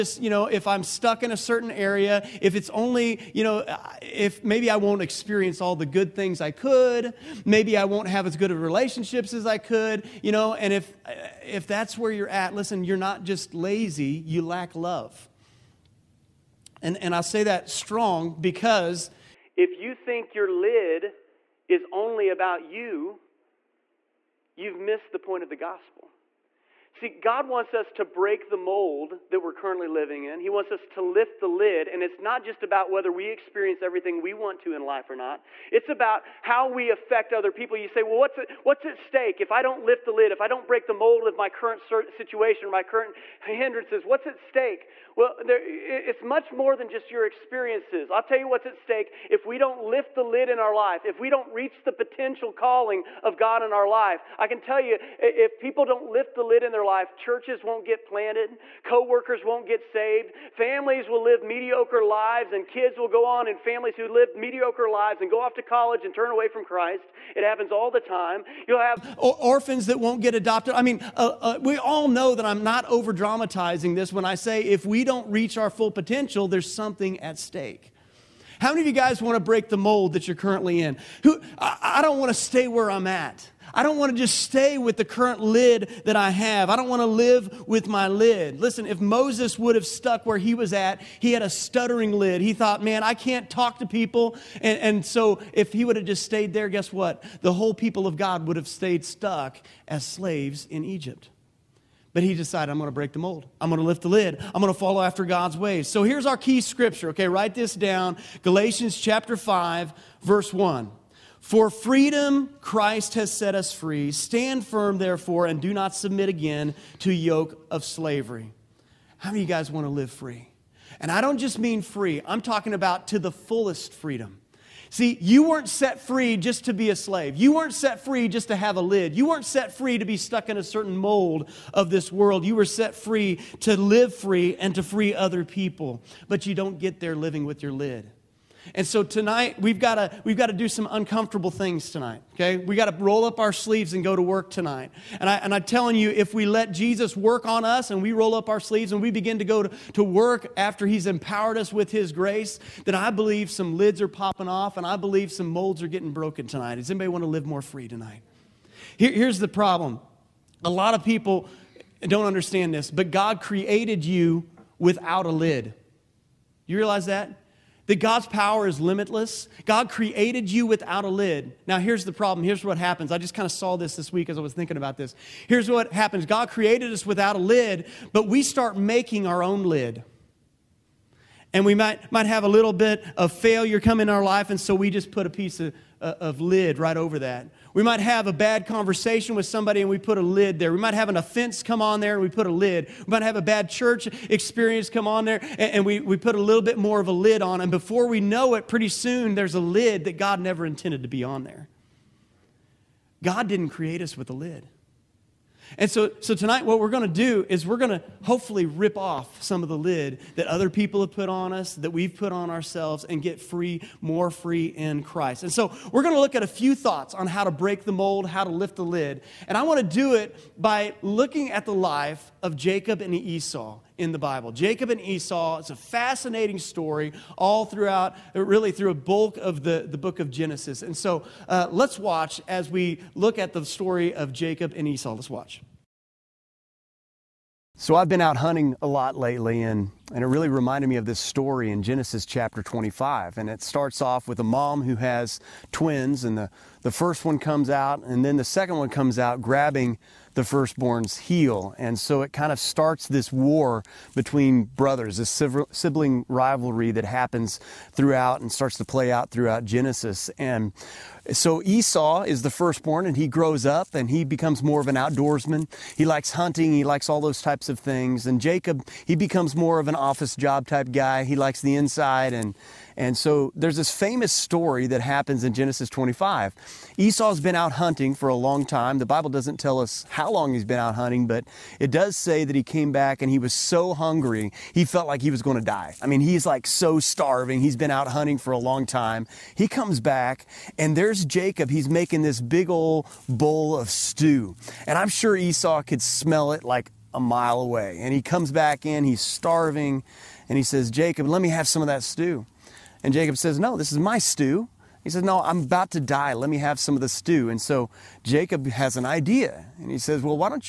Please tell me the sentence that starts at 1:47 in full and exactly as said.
Okay, write this down Galatians chapter 5, verse 1.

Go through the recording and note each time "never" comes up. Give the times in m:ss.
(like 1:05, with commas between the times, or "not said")
3:20.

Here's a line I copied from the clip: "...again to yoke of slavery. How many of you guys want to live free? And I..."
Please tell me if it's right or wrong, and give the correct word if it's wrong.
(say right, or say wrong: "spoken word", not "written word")
right.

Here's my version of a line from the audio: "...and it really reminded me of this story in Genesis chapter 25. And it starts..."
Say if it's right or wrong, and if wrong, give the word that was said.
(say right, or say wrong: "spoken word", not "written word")
right.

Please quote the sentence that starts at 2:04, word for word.
See, you weren't set free just to be a slave.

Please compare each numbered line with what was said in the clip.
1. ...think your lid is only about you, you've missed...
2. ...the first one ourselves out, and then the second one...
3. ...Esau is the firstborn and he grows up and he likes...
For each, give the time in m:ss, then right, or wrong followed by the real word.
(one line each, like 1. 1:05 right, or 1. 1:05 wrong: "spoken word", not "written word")
1. 0:19 right
2. 4:06 wrong: "comes", not "ourselves"
3. 4:21 wrong: "becomes", not "likes".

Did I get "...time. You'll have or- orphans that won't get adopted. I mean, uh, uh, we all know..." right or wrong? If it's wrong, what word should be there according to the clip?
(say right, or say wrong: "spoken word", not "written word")
right.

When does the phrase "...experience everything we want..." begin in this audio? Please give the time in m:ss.
0:33.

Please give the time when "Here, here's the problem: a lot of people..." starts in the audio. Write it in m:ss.
2:38.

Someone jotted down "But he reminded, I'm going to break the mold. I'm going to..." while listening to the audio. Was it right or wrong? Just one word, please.
wrong.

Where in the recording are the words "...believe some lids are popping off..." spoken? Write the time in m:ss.
2:33.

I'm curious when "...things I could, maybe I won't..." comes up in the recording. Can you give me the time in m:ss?
0:06.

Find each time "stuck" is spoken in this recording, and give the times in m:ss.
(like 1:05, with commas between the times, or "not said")
0:00, 1:29, 1:39, 2:10.